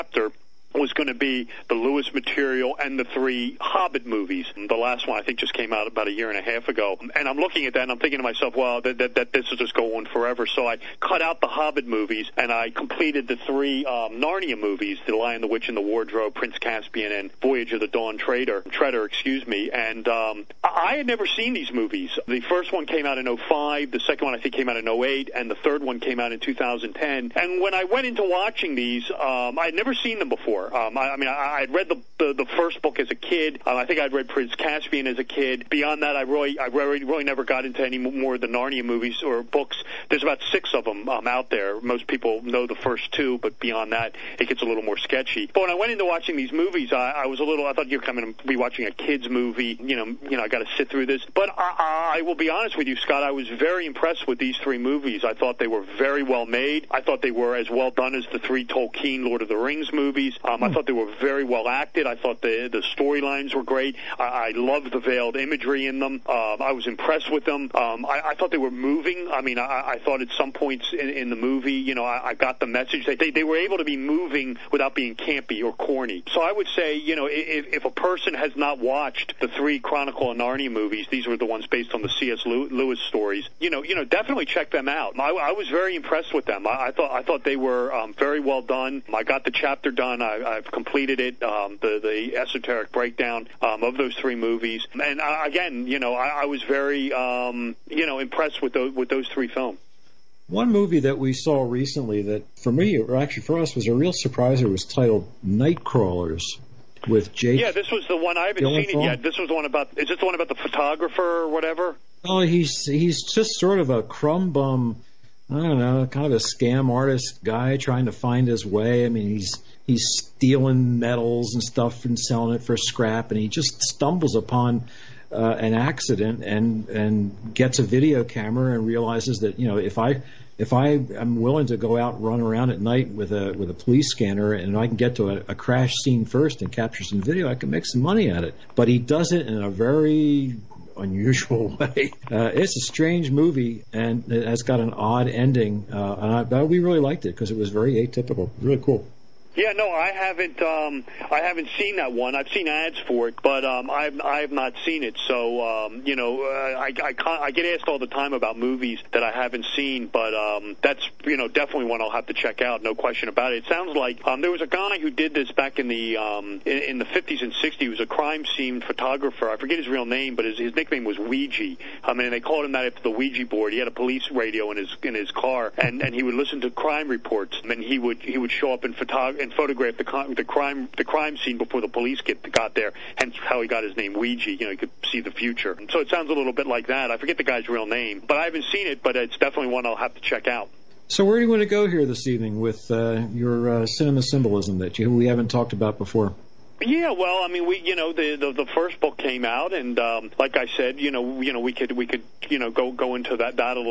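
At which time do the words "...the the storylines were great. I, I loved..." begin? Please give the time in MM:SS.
01:02.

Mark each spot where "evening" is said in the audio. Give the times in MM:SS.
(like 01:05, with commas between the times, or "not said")
03:12.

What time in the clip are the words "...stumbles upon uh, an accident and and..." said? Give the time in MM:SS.
02:03.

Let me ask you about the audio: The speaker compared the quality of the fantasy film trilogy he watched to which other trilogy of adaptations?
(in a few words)
Lord of the Rings.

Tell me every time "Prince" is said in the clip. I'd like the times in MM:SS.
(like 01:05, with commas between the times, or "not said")
00:16, 00:34.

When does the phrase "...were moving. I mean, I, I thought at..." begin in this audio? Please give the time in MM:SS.
01:08.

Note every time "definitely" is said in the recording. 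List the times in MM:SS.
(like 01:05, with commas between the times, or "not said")
01:24, 02:41, 03:09.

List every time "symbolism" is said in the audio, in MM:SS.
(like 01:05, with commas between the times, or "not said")
03:14.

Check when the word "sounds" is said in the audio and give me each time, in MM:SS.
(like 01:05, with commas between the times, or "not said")
02:43, 03:06.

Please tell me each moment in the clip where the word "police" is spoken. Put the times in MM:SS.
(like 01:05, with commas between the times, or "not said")
02:13, 02:53, 03:01.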